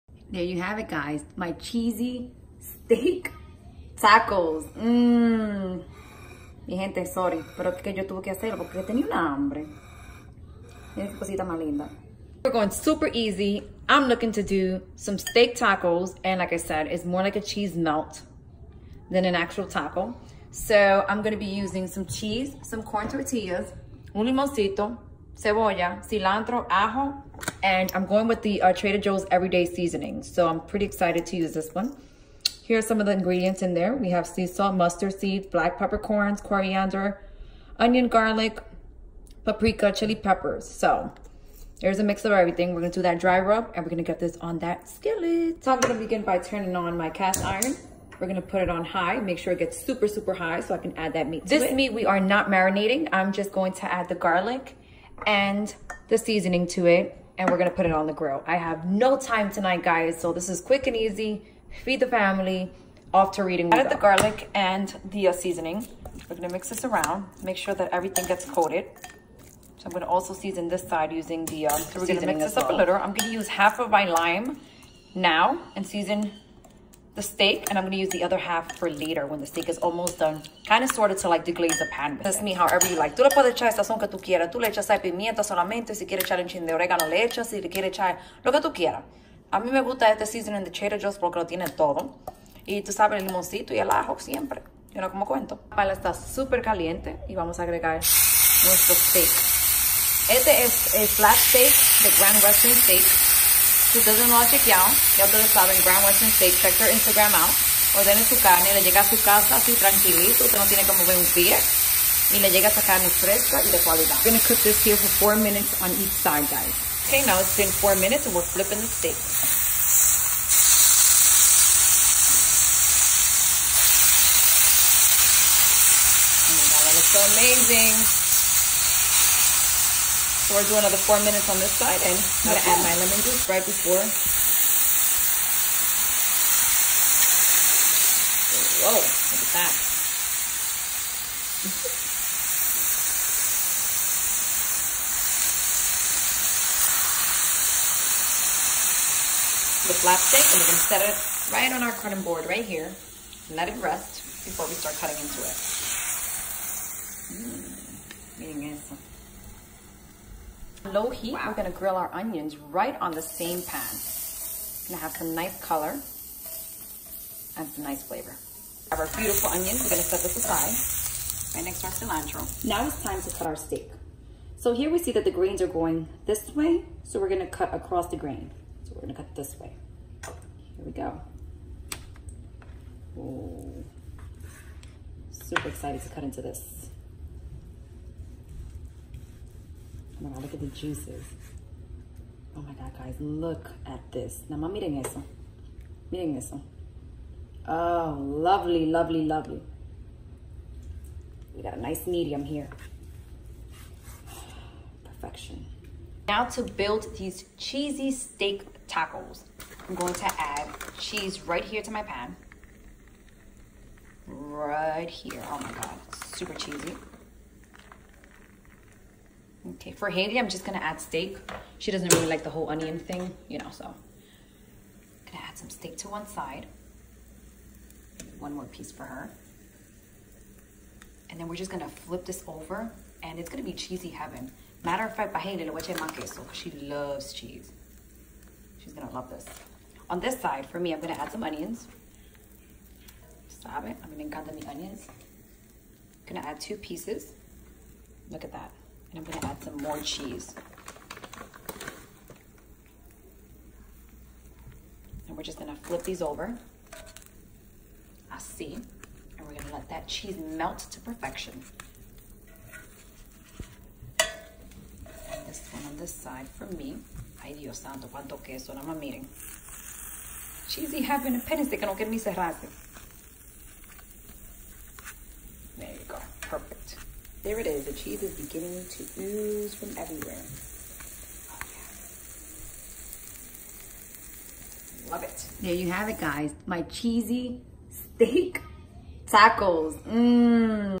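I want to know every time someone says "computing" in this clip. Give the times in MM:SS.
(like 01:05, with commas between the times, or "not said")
not said.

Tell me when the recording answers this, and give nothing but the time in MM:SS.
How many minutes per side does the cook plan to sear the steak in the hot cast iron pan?
01:55.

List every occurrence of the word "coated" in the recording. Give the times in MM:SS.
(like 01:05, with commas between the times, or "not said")
01:08.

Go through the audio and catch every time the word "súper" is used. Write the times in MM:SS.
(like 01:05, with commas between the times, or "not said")
01:36.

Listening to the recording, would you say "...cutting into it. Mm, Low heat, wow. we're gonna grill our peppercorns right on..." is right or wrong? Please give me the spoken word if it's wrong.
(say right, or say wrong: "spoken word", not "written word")
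wrong: "onions", not "peppercorns".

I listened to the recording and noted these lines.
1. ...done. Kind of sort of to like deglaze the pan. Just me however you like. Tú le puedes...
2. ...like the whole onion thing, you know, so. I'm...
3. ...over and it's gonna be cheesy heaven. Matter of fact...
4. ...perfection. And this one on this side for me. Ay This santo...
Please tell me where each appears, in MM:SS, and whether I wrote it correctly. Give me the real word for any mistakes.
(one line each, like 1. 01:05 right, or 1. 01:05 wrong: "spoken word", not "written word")
1. 01:20 right
2. 03:42 right
3. 03:52 right
4. 04:21 wrong: "Dios", not "This".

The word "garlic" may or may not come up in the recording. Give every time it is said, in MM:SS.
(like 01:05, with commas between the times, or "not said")
00:38, 00:54, 01:03.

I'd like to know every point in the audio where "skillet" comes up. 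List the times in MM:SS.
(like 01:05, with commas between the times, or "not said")
00:44.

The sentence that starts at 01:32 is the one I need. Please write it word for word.
Y tú sabes el limoncito y el ajo siempre.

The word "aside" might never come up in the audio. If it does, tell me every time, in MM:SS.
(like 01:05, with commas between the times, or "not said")
02:50.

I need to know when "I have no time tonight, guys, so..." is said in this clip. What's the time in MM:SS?
00:58.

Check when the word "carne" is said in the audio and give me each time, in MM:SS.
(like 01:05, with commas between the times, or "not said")
01:48, 01:52.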